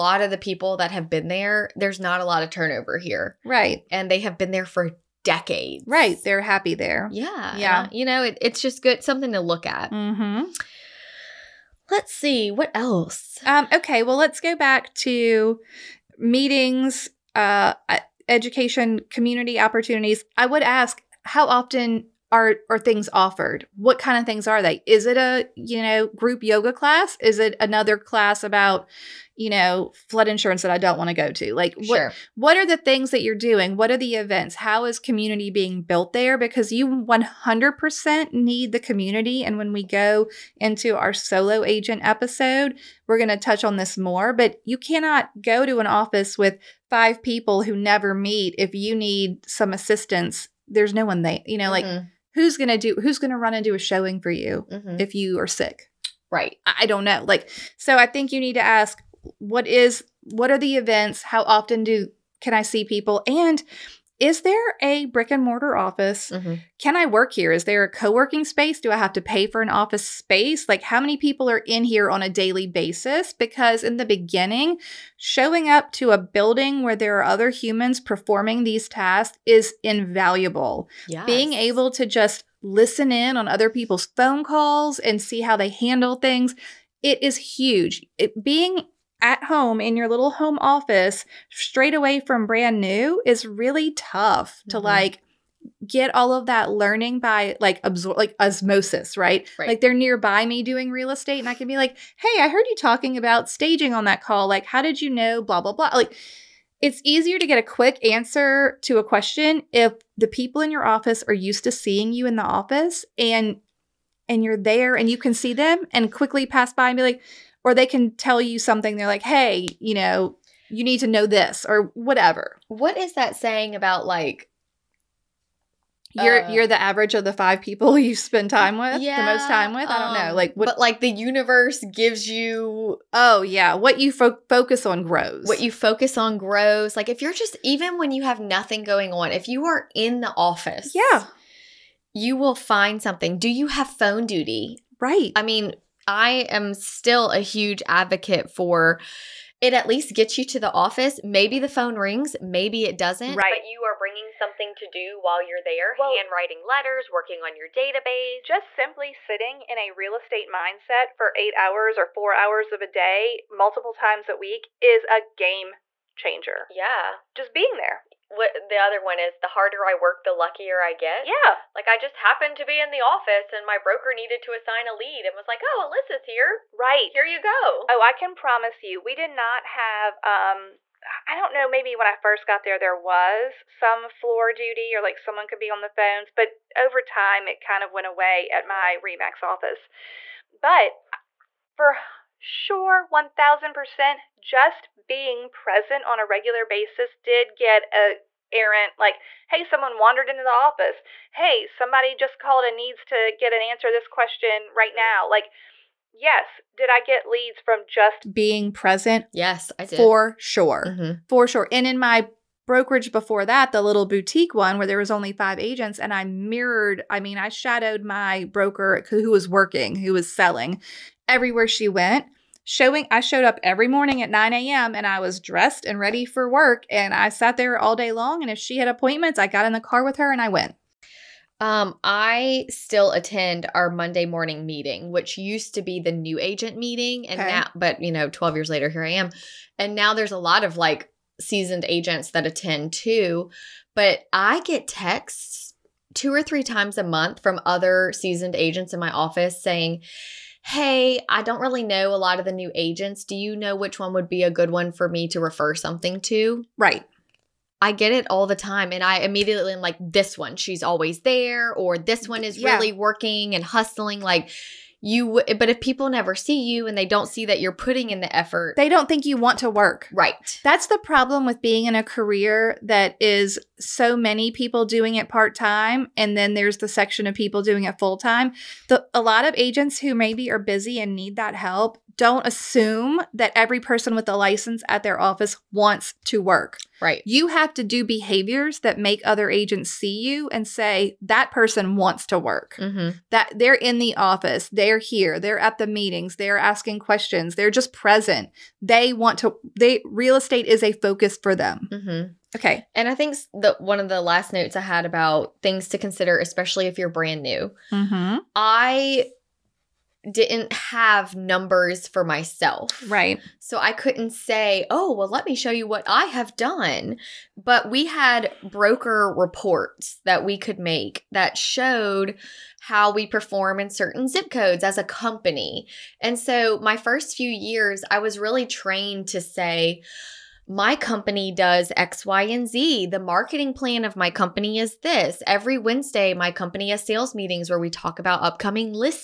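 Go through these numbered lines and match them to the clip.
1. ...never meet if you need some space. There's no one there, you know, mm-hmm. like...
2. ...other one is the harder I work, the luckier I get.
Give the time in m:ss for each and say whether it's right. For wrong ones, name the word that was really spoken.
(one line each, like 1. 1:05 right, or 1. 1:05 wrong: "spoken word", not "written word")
1. 0:47 wrong: "assistance", not "space"
2. 2:48 right.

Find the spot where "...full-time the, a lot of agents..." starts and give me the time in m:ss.
4:37.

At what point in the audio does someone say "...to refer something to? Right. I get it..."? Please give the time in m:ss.
4:15.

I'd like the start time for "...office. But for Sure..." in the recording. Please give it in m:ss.
3:09.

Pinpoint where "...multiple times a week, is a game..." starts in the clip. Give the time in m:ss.
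2:43.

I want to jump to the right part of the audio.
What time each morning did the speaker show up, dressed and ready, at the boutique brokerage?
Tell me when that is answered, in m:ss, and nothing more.
3:44.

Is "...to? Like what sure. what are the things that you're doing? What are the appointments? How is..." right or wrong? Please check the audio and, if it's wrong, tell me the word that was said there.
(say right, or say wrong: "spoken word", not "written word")
wrong: "events", not "appointments".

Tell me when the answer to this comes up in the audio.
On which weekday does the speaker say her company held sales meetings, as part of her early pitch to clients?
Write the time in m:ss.
5:35.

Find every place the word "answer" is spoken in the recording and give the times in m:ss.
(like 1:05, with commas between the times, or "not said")
1:48, 3:23.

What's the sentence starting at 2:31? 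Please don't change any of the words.
Maybe the phone rings, maybe it doesn't.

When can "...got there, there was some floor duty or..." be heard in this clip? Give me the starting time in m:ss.
3:02.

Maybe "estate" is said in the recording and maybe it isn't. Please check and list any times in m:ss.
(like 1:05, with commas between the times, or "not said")
1:41, 2:40, 5:00.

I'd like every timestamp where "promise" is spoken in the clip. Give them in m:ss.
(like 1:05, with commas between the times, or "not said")
2:58.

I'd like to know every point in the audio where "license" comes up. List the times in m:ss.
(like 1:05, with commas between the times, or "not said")
4:44.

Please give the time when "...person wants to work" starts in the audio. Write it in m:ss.
4:51.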